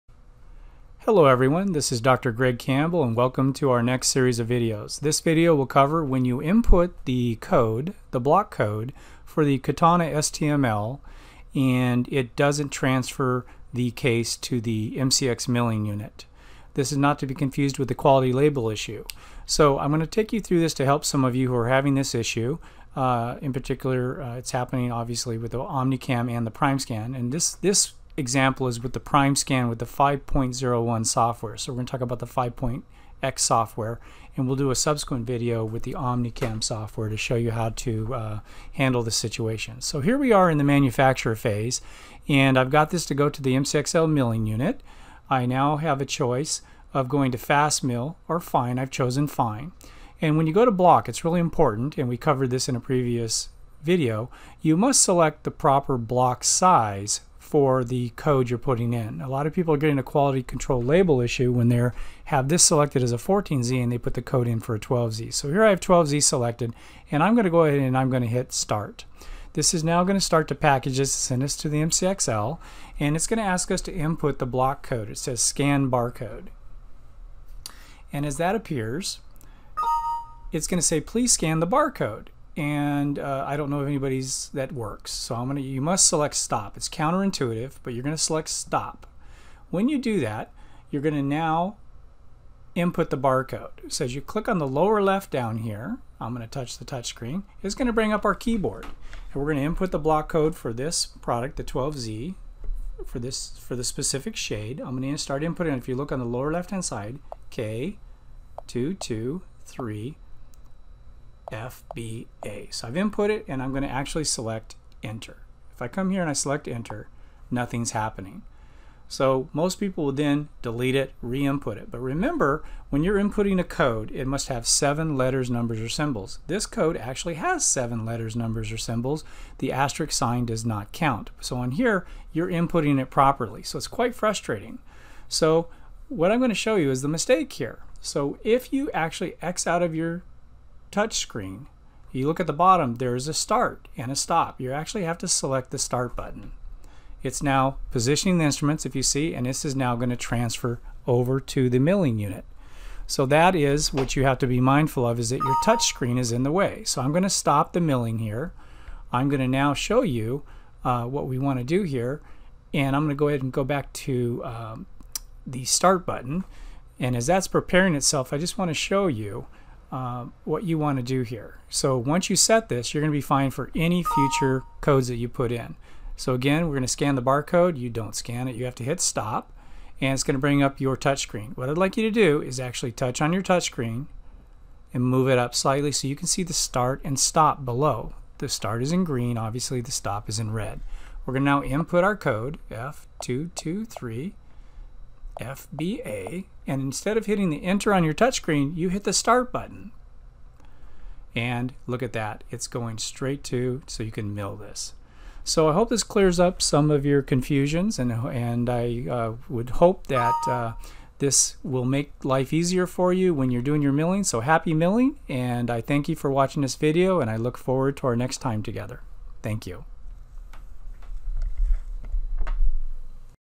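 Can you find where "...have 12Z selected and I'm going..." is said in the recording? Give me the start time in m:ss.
1:05.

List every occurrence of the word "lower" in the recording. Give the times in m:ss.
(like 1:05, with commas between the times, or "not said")
1:34, 1:46.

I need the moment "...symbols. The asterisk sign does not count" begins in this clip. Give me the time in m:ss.
2:08.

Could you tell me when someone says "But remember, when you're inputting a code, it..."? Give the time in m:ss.
2:01.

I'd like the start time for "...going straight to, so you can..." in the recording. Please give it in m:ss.
3:22.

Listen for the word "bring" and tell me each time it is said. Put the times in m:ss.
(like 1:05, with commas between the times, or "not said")
1:37, 3:00.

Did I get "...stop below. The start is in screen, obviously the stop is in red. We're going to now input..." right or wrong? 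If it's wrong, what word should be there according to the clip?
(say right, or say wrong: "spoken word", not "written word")
wrong: "green", not "screen".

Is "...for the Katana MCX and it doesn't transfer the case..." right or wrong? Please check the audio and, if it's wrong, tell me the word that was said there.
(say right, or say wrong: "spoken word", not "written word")
wrong: "STML", not "MCX".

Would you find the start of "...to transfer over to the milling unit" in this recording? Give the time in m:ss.
2:30.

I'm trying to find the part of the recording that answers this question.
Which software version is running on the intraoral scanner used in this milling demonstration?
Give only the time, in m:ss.
0:29.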